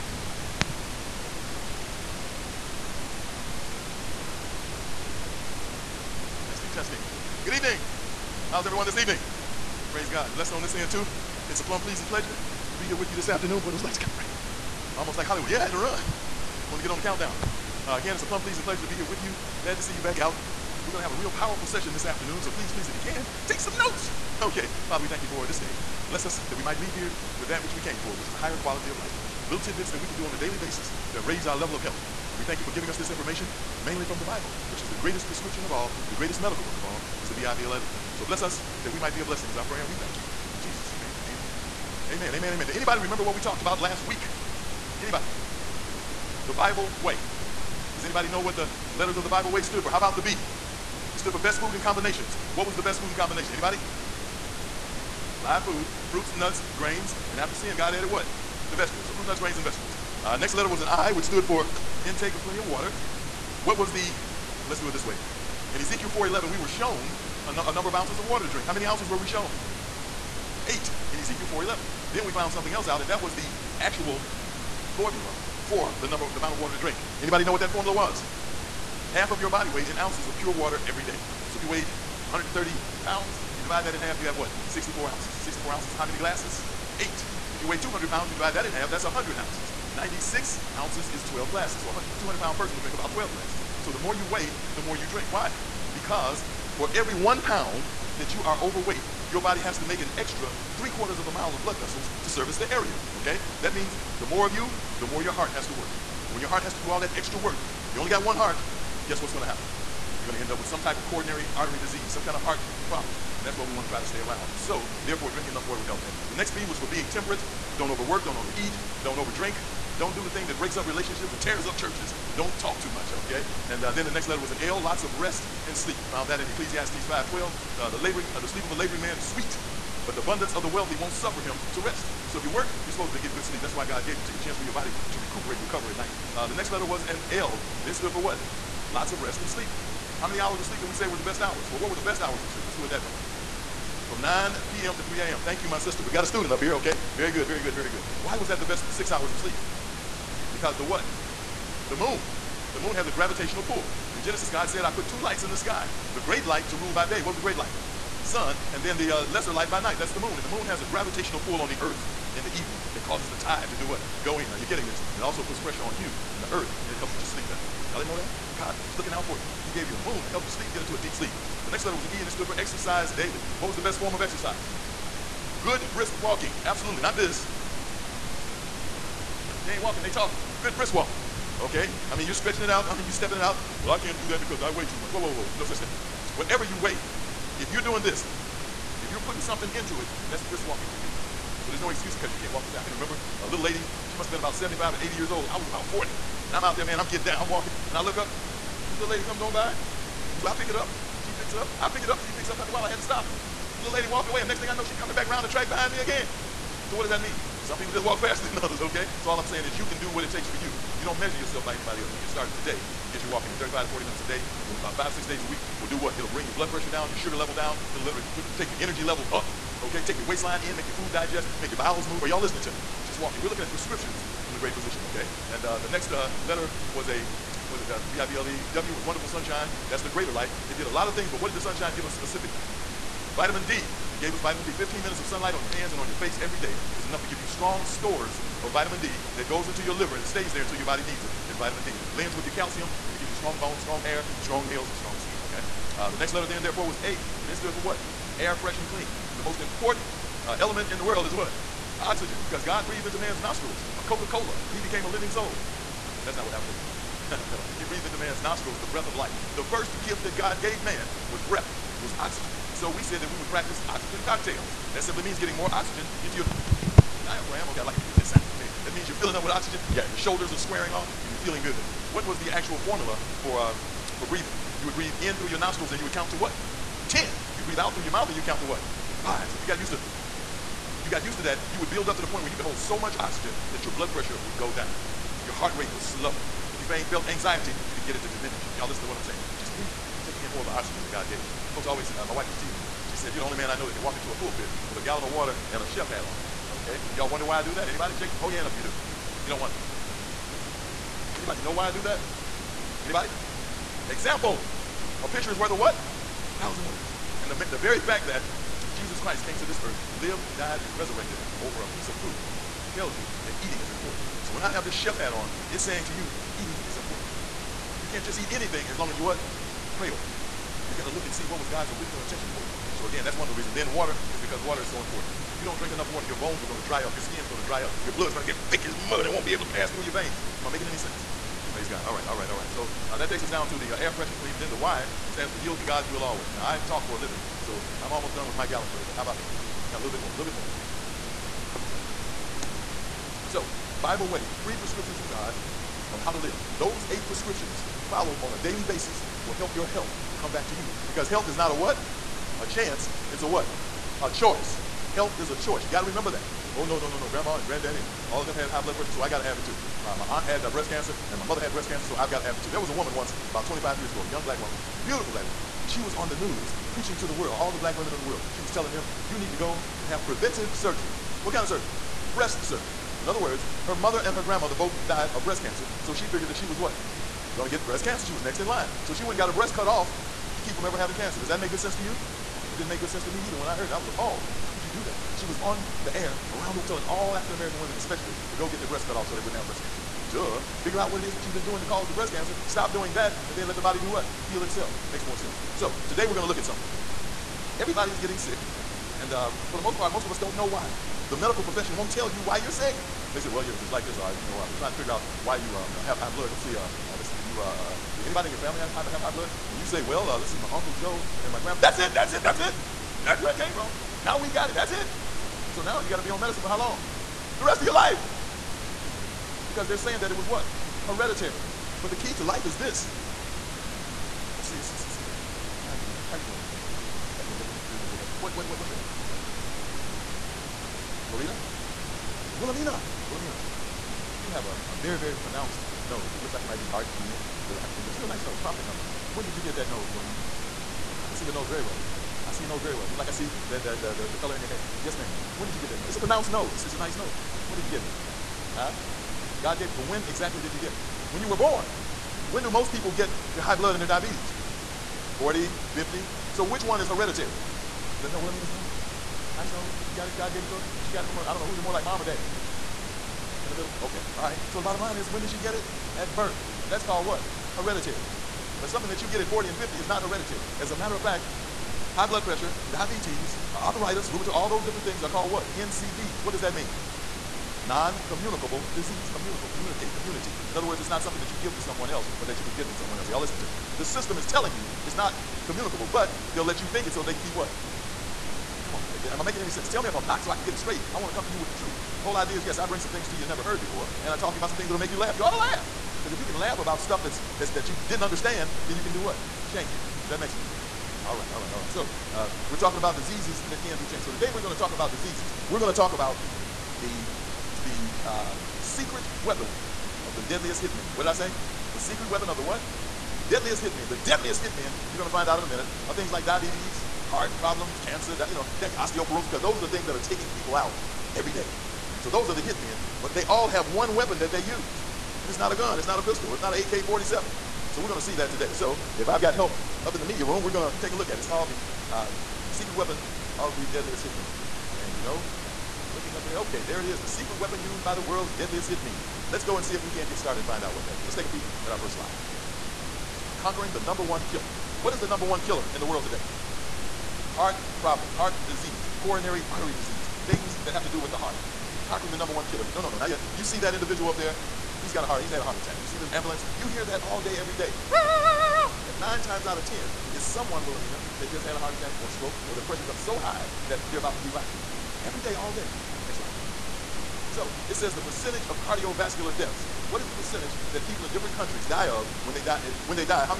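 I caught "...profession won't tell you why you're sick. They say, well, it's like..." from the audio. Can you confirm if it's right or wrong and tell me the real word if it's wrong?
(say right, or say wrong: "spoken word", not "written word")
right.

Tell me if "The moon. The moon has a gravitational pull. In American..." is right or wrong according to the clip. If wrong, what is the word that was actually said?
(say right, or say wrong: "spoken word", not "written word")
wrong: "Genesis", not "American".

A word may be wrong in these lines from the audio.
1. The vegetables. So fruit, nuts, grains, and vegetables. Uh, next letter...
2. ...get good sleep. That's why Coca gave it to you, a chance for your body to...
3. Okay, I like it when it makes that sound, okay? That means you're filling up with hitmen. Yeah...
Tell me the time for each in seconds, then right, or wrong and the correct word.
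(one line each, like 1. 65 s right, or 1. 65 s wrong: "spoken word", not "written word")
1. 58 s right
2. 133 s wrong: "God", not "Coca"
3. 267 s wrong: "oxygen", not "hitmen".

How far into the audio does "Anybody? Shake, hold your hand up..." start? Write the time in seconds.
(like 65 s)
297 s.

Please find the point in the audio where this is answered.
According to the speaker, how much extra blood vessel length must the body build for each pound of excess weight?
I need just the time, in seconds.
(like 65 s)
100 s.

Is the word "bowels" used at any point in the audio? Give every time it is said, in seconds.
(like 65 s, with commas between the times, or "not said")
221 s.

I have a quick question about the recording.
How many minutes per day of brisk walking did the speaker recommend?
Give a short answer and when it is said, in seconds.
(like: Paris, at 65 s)
35 to 40 minutes, at 213 s.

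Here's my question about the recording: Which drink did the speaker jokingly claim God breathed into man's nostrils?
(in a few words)
Coca Cola.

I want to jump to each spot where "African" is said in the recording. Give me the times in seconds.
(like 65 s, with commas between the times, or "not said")
387 s, 437 s.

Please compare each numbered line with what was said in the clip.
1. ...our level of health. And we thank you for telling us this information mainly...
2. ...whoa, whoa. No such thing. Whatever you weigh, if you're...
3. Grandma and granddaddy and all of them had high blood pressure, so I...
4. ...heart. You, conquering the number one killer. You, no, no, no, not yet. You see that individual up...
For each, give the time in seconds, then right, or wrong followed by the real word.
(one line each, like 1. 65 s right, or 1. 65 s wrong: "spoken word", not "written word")
1. 31 s wrong: "giving", not "telling"
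2. 185 s right
3. 357 s right
4. 551 s right.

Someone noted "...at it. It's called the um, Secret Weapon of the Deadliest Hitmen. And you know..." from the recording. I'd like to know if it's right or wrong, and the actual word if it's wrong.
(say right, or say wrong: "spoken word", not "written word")
right.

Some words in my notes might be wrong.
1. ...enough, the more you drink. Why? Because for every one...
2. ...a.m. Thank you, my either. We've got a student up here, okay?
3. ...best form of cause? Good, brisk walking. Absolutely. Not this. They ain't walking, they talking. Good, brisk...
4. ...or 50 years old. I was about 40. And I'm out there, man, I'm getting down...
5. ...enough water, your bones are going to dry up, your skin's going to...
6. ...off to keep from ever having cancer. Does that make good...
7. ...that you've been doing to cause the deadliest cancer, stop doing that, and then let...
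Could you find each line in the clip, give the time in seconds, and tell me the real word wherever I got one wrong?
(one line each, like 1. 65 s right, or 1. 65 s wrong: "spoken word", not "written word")
1. 94 s wrong: "weigh", not "enough"
2. 145 s wrong: "sister", not "either"
3. 173 s wrong: "exercise", not "cause"
4. 194 s wrong: "80", not "50"
5. 325 s right
6. 379 s right
7. 391 s wrong: "breast", not "deadliest".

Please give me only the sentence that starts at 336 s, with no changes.
Now I talk for a living, so I'm almost done with my gallon for the day.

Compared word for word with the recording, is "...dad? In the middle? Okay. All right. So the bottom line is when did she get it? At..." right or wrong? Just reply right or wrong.
right.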